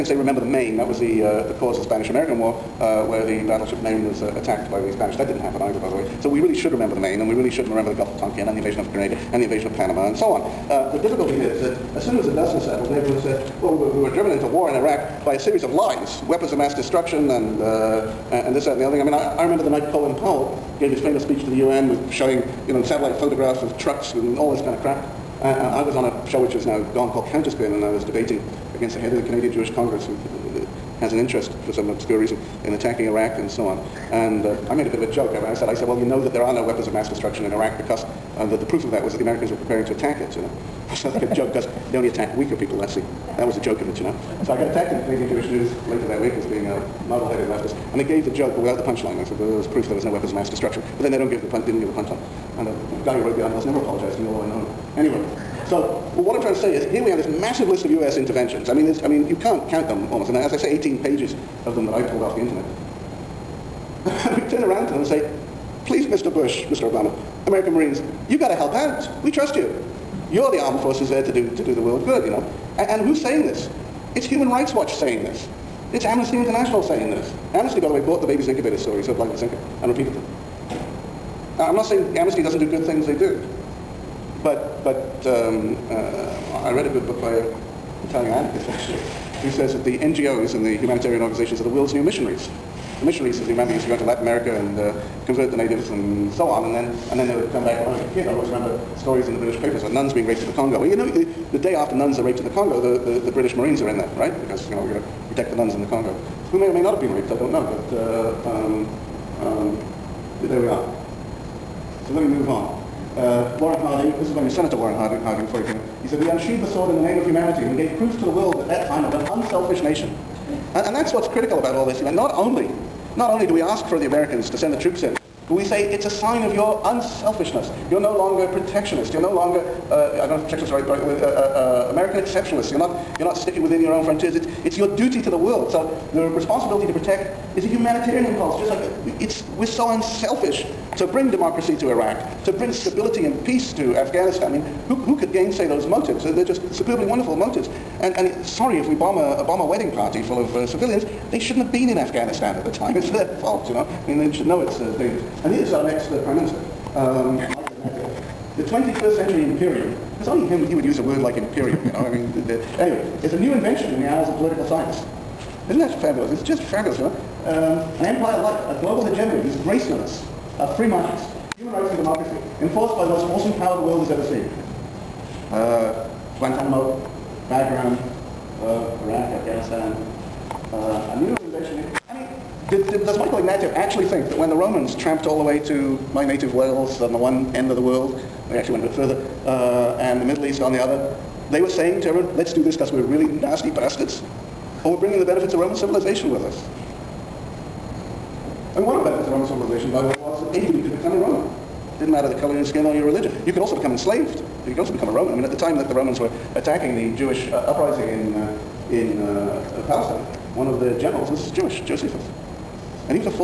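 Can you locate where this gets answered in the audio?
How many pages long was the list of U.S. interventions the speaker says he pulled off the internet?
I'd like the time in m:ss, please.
1:00.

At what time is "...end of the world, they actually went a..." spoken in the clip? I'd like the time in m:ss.
3:07.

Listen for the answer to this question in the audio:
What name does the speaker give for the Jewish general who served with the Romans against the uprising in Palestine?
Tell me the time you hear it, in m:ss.
3:31.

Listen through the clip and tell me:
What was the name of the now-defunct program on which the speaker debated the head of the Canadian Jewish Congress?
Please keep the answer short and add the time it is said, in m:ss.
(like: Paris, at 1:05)
Counterspin, at 0:27.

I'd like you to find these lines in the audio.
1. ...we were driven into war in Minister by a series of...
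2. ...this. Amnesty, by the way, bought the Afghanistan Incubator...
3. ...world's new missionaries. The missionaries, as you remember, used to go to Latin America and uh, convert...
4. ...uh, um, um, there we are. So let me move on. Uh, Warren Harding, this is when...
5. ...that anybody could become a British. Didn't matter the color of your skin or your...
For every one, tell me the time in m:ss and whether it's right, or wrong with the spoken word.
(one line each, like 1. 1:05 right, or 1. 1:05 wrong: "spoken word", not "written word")
1. 0:13 wrong: "Iraq", not "Minister"
2. 1:17 wrong: "Babies", not "Afghanistan"
3. 1:31 right
4. 1:47 right
5. 3:20 wrong: "Roman", not "British".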